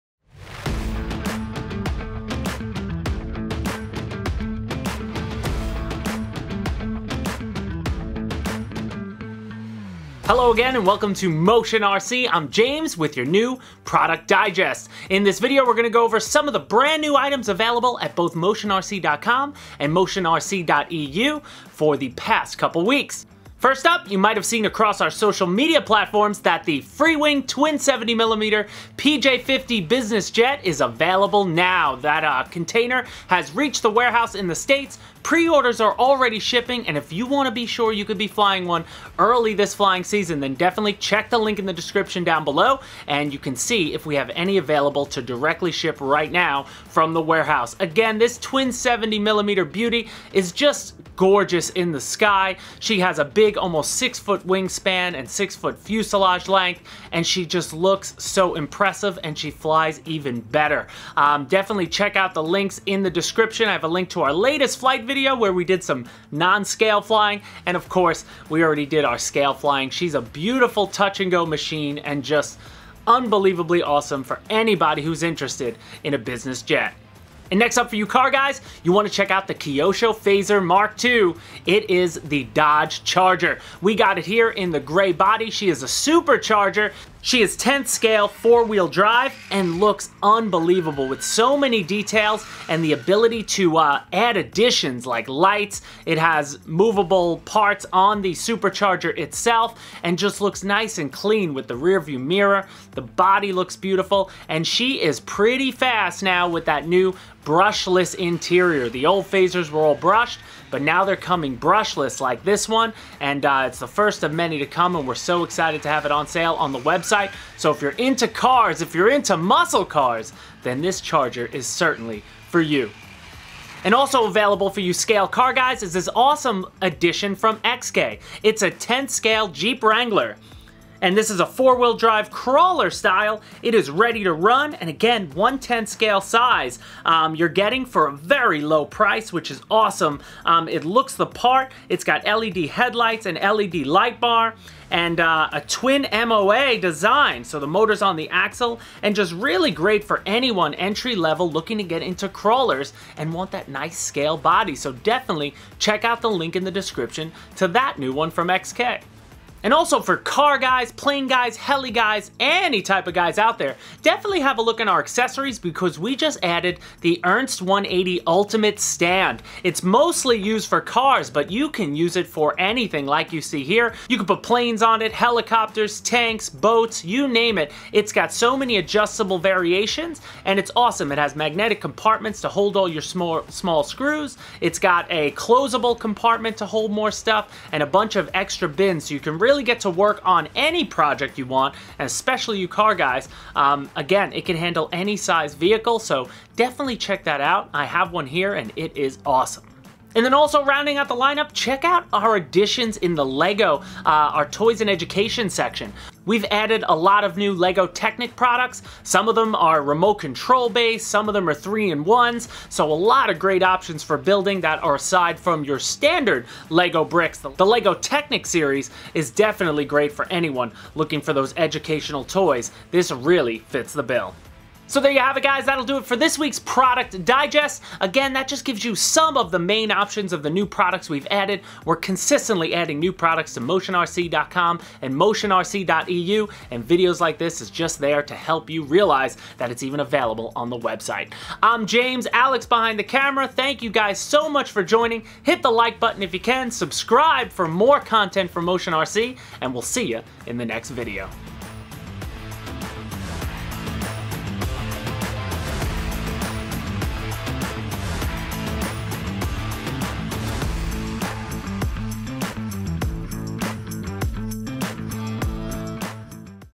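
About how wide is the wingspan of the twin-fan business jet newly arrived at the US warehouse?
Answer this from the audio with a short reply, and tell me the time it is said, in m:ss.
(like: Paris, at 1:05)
6 foot, at 0:53.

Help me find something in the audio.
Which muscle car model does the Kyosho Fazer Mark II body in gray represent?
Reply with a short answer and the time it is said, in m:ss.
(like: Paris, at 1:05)
Dodge Charger, at 1:22.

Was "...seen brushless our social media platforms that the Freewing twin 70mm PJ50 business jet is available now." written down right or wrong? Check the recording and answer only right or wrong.
wrong.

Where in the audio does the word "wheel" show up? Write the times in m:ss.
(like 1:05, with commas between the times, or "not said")
1:28, 2:11.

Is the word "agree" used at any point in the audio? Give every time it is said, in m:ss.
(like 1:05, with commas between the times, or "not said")
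not said.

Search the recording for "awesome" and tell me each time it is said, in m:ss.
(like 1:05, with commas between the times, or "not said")
1:13, 2:06, 2:19, 3:00, 3:19.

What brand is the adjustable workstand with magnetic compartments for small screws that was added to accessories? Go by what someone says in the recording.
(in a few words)
Ernst.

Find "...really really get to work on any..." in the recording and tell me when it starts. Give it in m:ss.
3:09.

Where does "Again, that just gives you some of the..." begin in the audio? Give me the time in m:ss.
3:48.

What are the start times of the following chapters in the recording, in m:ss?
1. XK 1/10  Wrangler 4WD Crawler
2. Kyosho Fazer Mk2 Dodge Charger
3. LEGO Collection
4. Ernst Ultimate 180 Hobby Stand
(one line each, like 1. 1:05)
1. 2:08
2. 1:18
3. 3:20
4. 2:42.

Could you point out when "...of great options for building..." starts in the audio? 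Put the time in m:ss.
3:33.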